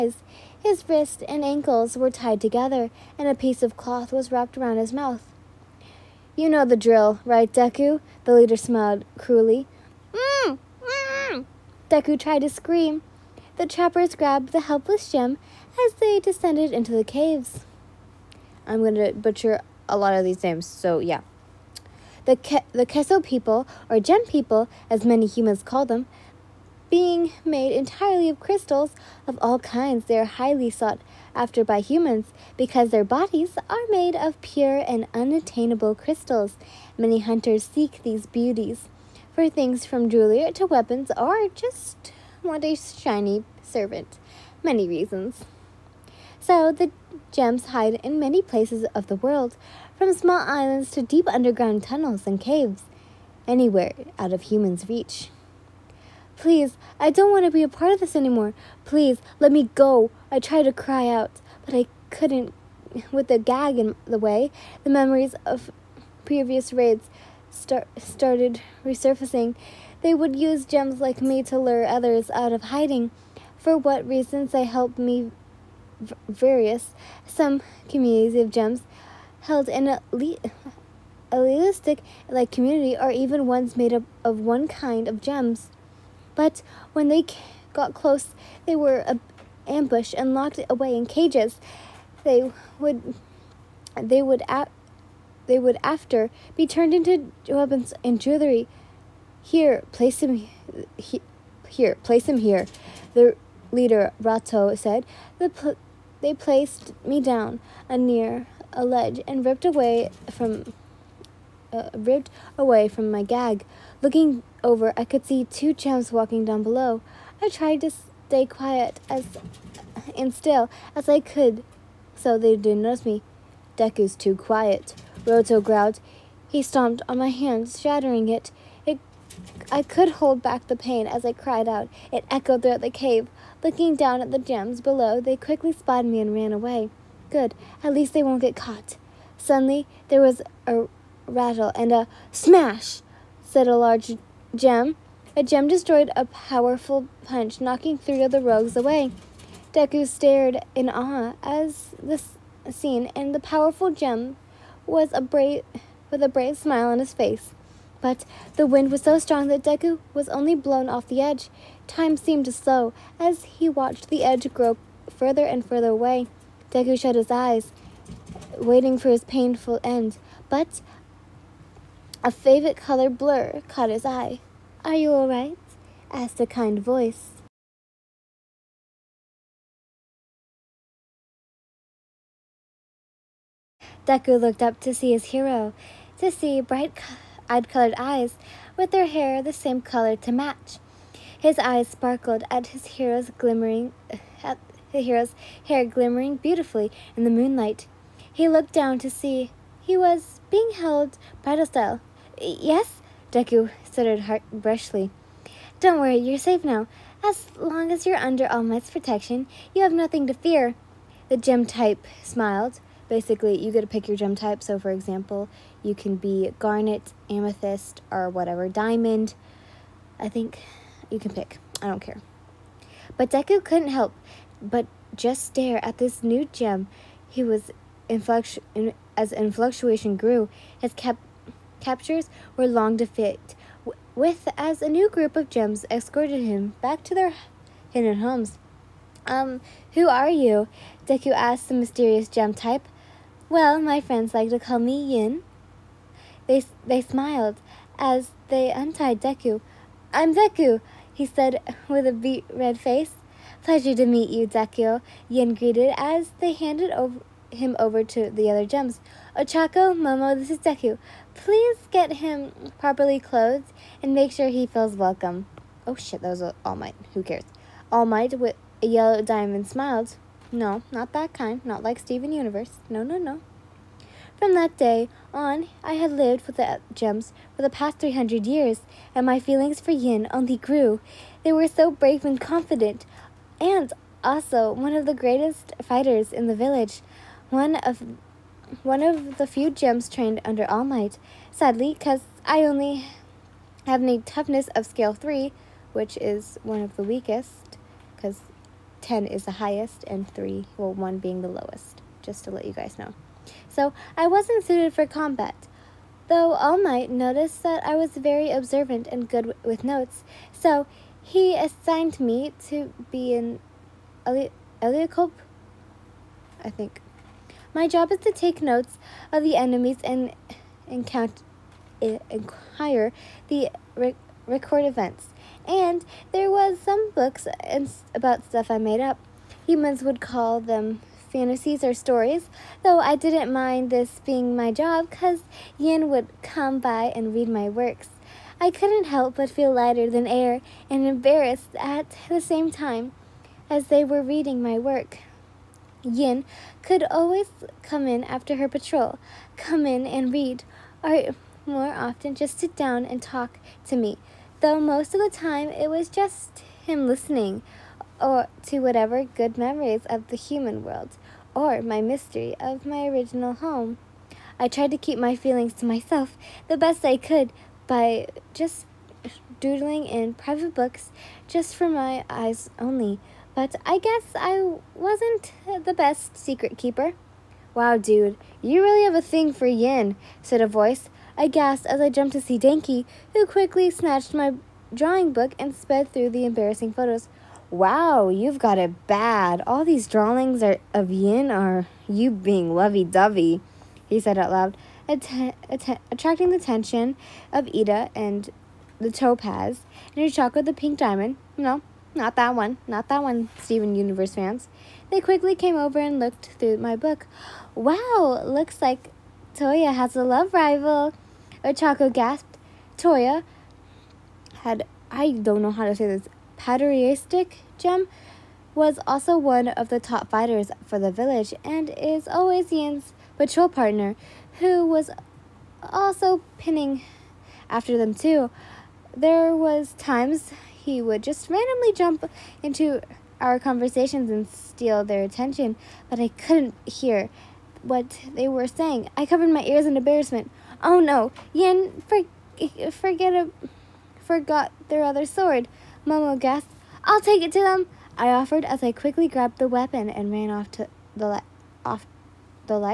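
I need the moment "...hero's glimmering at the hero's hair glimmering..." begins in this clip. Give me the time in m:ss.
3:12.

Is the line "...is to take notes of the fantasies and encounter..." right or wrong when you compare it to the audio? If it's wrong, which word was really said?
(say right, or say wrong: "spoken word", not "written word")
wrong: "enemies", not "fantasies".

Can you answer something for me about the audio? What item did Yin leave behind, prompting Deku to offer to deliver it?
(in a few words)
sword.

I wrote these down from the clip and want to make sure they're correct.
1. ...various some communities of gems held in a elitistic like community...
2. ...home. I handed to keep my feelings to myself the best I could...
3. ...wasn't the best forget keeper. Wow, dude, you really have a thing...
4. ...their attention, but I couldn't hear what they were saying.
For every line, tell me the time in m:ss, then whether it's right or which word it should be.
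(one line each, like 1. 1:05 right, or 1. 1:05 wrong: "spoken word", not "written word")
1. 1:16 right
2. 6:03 wrong: "tried", not "handed"
3. 6:14 wrong: "secret", not "forget"
4. 7:15 right.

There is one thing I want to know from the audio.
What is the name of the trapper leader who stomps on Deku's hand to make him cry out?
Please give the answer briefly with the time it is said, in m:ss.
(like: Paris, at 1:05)
Roto, at 2:05.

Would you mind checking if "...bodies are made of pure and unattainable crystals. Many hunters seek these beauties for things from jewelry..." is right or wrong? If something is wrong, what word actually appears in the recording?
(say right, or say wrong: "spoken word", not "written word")
right.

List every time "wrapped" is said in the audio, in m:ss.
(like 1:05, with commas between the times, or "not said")
0:04.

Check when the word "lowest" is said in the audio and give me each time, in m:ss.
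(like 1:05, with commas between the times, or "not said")
5:01.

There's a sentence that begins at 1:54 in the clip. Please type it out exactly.
Looking over, I could see two chumps walking down below.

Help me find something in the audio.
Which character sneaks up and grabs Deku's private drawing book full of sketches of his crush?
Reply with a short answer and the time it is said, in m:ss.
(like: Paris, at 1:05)
Denki, at 6:22.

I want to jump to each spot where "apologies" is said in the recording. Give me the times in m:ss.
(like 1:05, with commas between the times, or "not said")
not said.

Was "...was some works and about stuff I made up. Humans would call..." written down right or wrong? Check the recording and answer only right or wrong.
wrong.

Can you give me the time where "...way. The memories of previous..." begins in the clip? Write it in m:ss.
1:04.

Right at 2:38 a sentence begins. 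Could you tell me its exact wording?
But the wind was so strong that Deku was only blown off the edge.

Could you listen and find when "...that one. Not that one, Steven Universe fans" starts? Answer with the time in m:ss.
6:42.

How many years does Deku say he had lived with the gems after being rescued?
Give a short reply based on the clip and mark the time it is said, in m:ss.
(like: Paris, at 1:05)
300, at 4:37.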